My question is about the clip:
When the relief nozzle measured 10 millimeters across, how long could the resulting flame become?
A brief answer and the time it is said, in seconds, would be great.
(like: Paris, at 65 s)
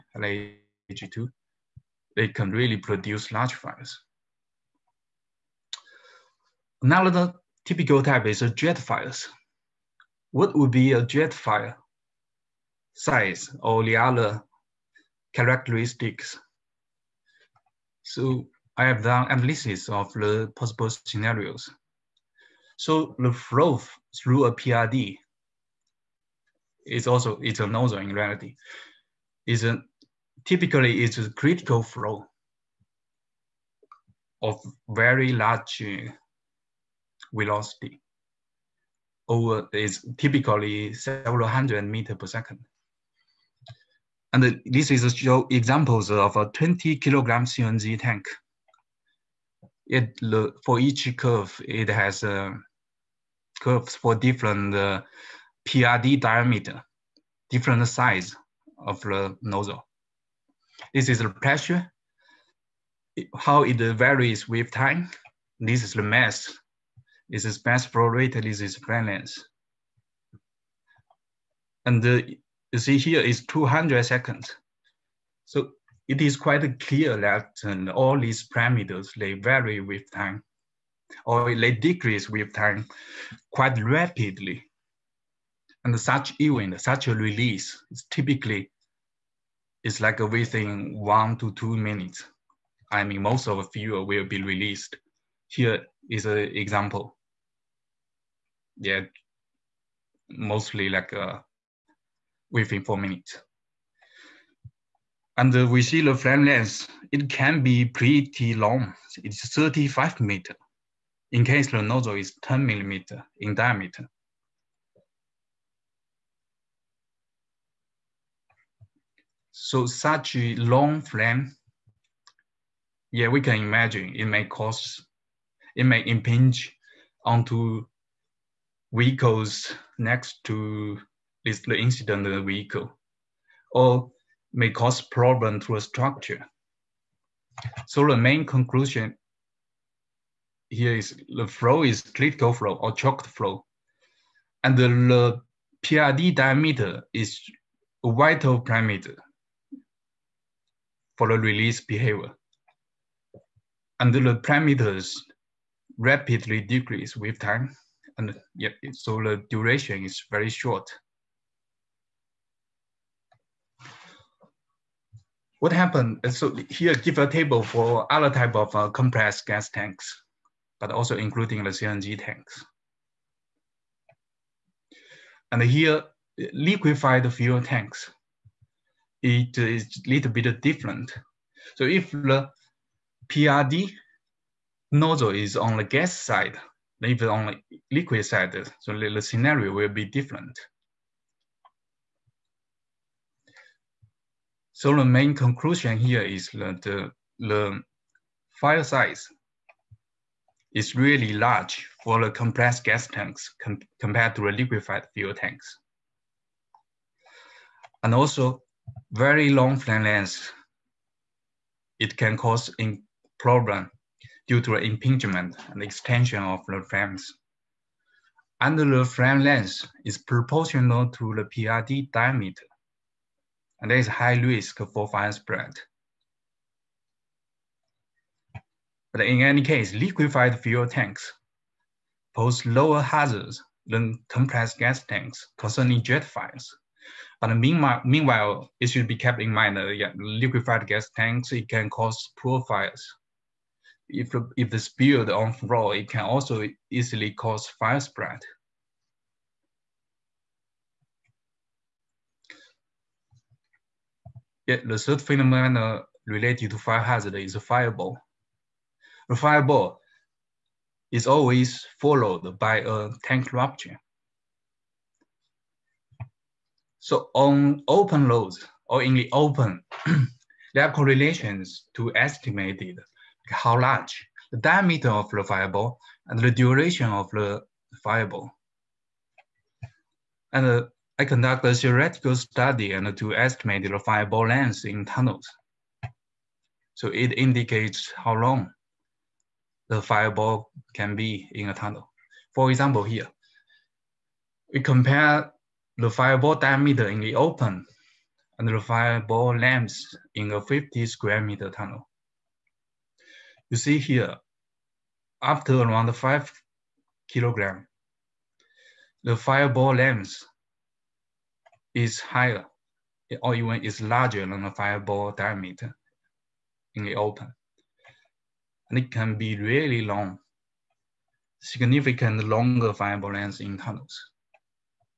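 35 meters, at 109 s.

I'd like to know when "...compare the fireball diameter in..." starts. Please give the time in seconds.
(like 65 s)
294 s.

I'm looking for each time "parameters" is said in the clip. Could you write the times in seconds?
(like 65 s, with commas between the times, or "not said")
78 s, 148 s, 154 s.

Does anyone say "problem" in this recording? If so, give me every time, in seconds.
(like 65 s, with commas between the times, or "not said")
135 s, 213 s.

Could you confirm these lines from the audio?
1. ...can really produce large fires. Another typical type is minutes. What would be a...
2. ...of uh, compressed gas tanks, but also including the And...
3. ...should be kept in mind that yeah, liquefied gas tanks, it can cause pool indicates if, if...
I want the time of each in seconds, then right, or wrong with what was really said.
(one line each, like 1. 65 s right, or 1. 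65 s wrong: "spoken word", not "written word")
1. 2 s wrong: "fires", not "minutes"
2. 168 s wrong: "CNG", not "And"
3. 238 s wrong: "fires", not "indicates".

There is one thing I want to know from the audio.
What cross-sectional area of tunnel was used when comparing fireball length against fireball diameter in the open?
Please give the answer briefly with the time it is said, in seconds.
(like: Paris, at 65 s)
50 square meters, at 300 s.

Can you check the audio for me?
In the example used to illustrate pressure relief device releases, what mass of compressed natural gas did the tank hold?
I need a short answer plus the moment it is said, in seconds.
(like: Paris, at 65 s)
20 kilograms, at 46 s.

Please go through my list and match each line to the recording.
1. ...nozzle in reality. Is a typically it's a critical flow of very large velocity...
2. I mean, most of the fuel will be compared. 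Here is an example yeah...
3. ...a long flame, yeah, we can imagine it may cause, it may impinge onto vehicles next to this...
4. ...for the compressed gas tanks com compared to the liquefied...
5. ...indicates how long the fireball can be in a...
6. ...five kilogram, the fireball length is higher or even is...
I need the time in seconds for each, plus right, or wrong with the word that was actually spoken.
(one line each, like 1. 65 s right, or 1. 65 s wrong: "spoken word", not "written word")
1. 27 s right
2. 92 s wrong: "released", not "compared"
3. 120 s right
4. 202 s right
5. 287 s right
6. 306 s right.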